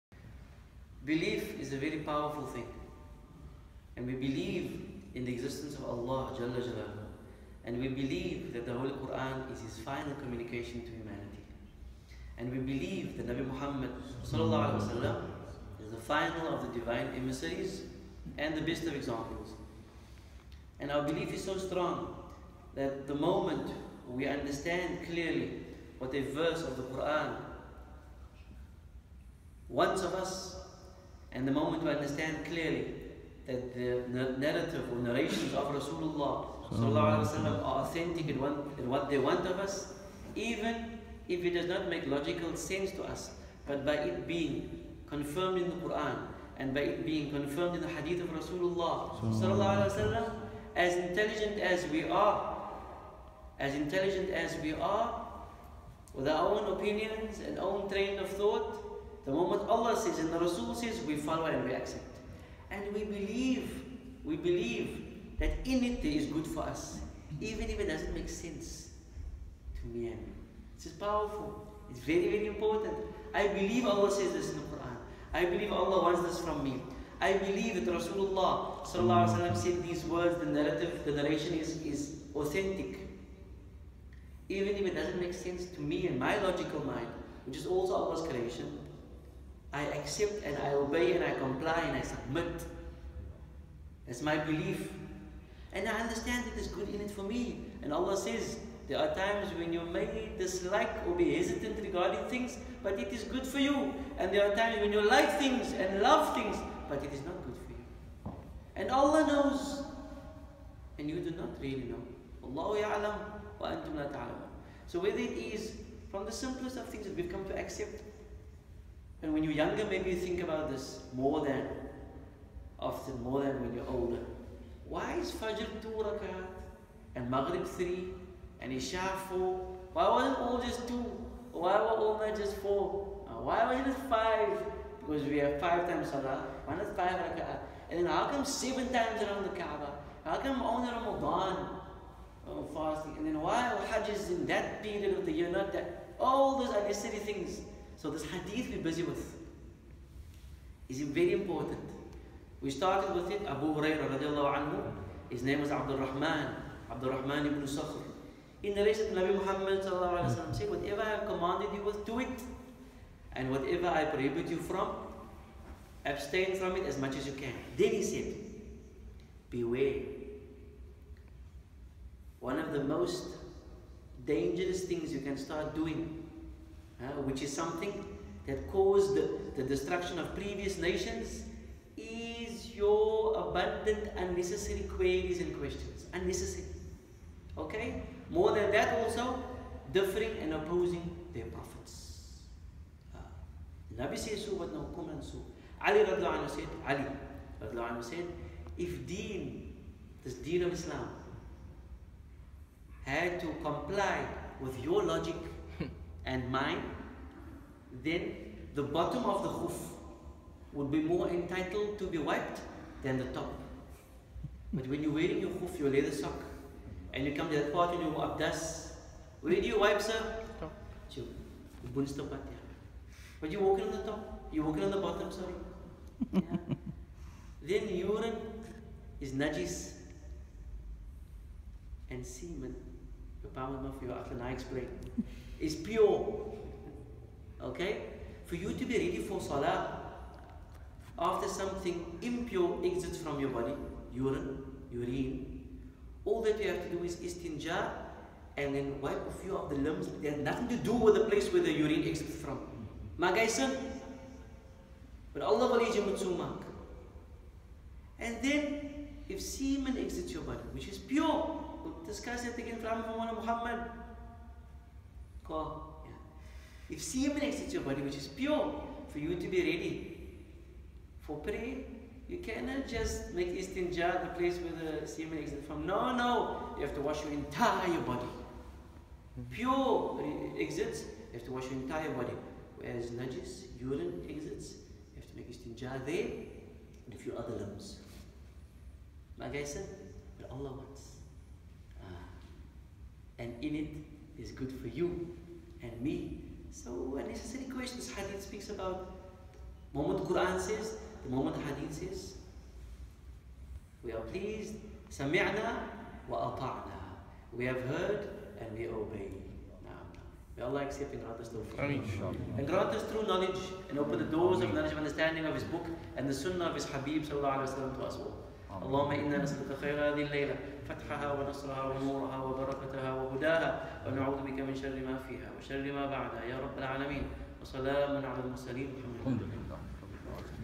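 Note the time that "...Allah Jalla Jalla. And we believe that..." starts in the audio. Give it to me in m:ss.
0:05.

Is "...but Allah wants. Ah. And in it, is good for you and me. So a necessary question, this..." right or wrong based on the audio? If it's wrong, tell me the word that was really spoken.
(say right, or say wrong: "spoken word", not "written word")
right.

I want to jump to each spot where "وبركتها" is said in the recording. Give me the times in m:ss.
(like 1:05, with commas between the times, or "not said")
5:22.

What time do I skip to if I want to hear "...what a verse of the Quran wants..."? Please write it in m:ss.
0:25.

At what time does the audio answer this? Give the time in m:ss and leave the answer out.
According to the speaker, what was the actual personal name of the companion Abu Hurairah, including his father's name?
2:36.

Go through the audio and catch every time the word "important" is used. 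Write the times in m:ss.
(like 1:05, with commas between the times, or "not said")
1:12, 2:31.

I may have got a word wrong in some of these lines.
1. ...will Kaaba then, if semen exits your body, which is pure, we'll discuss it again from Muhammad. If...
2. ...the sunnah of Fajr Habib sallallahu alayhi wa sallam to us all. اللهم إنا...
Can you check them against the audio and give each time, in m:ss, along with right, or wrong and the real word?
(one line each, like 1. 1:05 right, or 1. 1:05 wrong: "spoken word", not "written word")
1. 4:15 wrong: "And", not "Kaaba"
2. 5:16 wrong: "His", not "Fajr".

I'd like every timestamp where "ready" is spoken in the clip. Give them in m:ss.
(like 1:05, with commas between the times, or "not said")
3:58, 4:29.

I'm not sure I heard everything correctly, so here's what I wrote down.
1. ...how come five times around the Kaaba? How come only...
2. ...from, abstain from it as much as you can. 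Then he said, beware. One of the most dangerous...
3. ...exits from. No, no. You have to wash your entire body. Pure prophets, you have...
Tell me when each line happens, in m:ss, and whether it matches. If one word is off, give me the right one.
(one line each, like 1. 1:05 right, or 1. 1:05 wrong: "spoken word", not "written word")
1. 2:18 wrong: "seven", not "five"
2. 2:44 right
3. 4:35 wrong: "exits", not "prophets".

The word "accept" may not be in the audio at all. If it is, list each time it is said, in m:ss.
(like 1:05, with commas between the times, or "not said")
1:01, 1:29, 1:57, 5:10.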